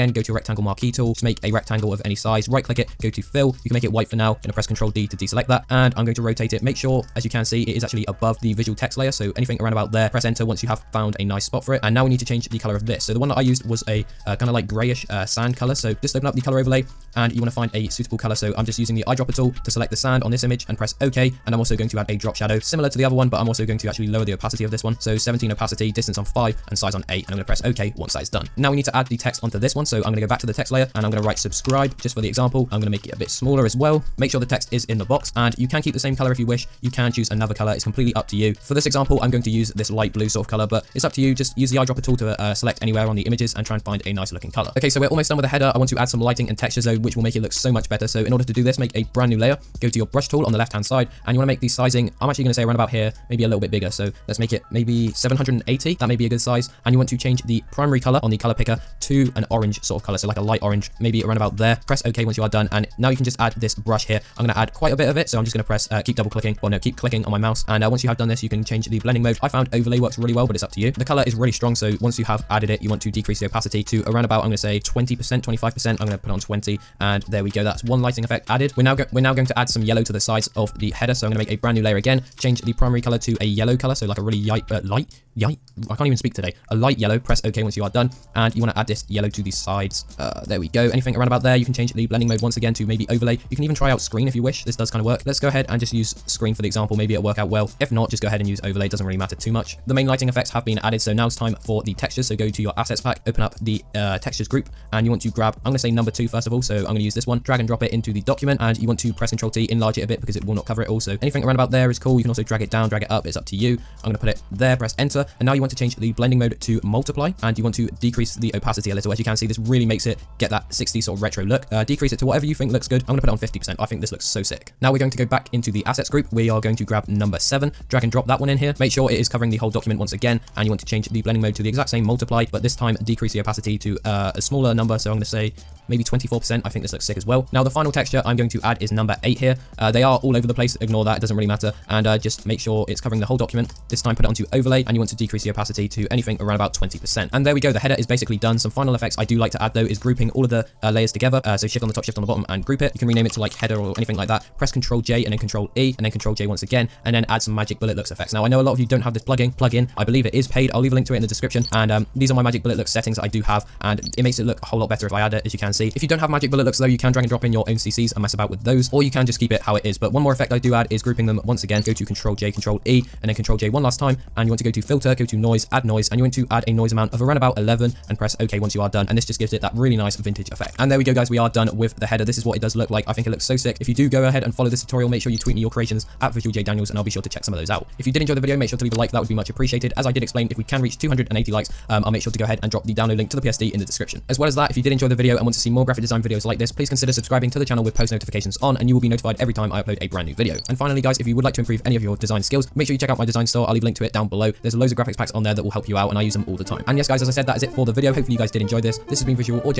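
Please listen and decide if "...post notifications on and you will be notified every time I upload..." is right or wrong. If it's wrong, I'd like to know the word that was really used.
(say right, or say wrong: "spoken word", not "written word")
right.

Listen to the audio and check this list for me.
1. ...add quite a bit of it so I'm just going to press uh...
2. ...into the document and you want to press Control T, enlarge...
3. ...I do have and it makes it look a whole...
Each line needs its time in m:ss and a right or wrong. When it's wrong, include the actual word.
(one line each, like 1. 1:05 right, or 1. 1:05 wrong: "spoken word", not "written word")
1. 1:04 right
2. 1:47 right
3. 2:43 right.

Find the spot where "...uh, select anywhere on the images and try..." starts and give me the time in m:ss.
0:42.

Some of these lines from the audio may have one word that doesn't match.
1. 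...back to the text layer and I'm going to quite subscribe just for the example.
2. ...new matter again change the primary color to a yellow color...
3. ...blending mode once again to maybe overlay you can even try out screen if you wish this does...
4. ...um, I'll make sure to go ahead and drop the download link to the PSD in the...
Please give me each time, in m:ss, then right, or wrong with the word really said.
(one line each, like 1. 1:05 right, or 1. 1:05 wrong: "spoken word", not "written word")
1. 0:30 wrong: "write", not "quite"
2. 1:21 wrong: "layer", not "matter"
3. 1:32 right
4. 3:11 right.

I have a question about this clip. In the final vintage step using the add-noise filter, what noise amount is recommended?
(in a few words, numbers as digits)
11.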